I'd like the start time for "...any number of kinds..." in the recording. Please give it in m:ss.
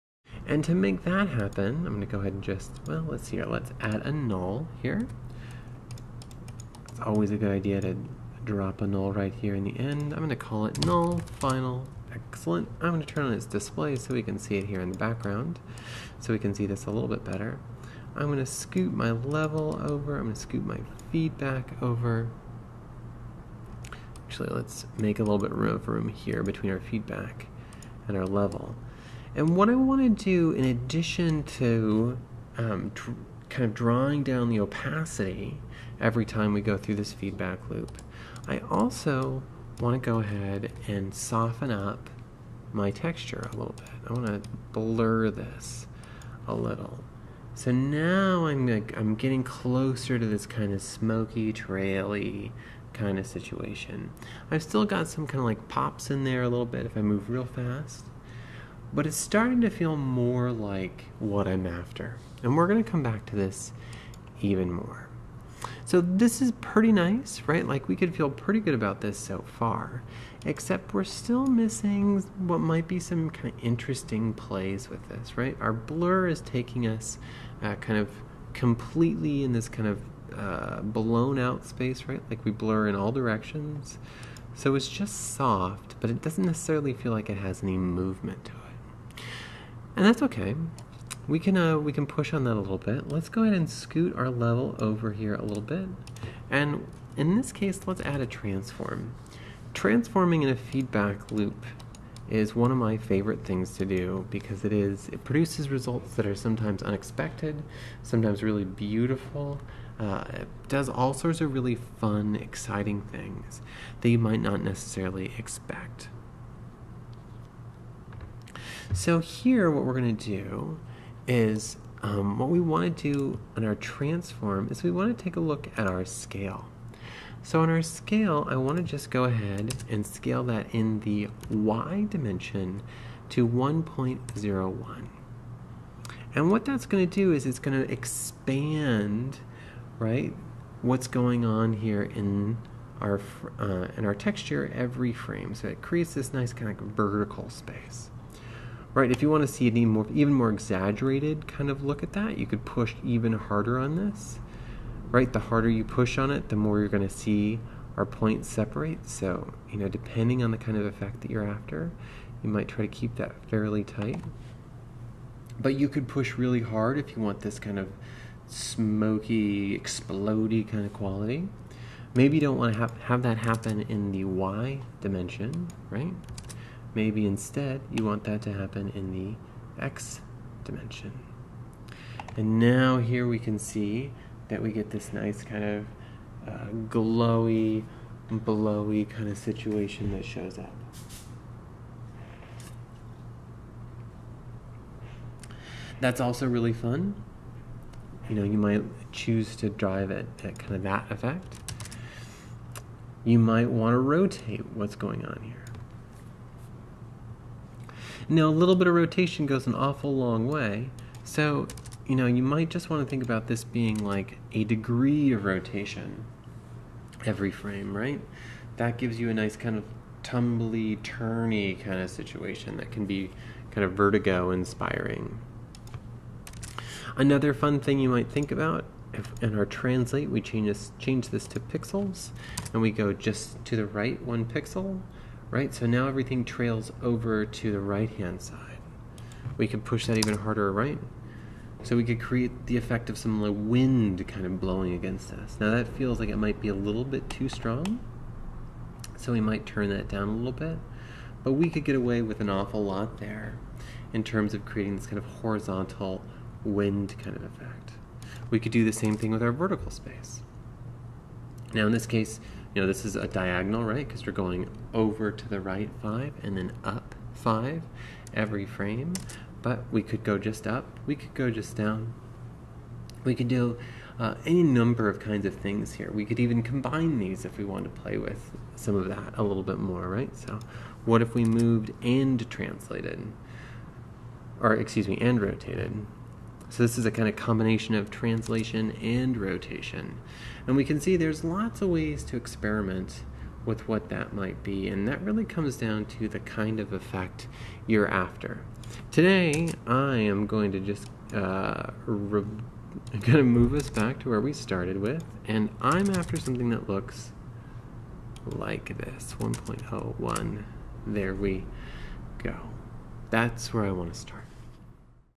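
4:34.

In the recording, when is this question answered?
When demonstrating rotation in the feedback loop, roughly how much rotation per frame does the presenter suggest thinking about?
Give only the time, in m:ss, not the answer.
3:34.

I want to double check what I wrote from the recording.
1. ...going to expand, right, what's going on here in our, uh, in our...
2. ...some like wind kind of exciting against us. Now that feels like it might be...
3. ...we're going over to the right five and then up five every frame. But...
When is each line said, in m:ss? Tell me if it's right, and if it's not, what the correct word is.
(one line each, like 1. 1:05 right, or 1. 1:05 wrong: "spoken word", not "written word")
1. 2:17 right
2. 4:03 wrong: "blowing", not "exciting"
3. 4:24 right.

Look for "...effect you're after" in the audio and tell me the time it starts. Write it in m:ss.
4:56.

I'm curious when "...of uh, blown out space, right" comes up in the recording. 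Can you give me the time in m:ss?
1:19.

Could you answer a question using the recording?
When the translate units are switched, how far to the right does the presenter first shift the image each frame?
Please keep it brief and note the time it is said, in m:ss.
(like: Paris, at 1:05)
one pixel, at 3:54.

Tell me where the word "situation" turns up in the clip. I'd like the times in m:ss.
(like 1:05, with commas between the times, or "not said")
0:53, 3:09, 3:42.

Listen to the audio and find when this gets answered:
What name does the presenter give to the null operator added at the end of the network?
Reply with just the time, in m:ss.
0:10.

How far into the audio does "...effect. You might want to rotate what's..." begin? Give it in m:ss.
3:21.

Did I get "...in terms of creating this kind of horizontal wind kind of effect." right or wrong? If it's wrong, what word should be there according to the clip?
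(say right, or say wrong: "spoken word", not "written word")
right.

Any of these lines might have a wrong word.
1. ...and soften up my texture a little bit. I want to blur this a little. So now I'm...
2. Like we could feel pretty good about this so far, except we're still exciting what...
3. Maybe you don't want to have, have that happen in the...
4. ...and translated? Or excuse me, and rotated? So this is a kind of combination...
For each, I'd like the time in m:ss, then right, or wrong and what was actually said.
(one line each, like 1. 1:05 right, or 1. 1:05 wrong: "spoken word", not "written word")
1. 0:40 right
2. 1:07 wrong: "missing", not "exciting"
3. 2:52 right
4. 4:42 right.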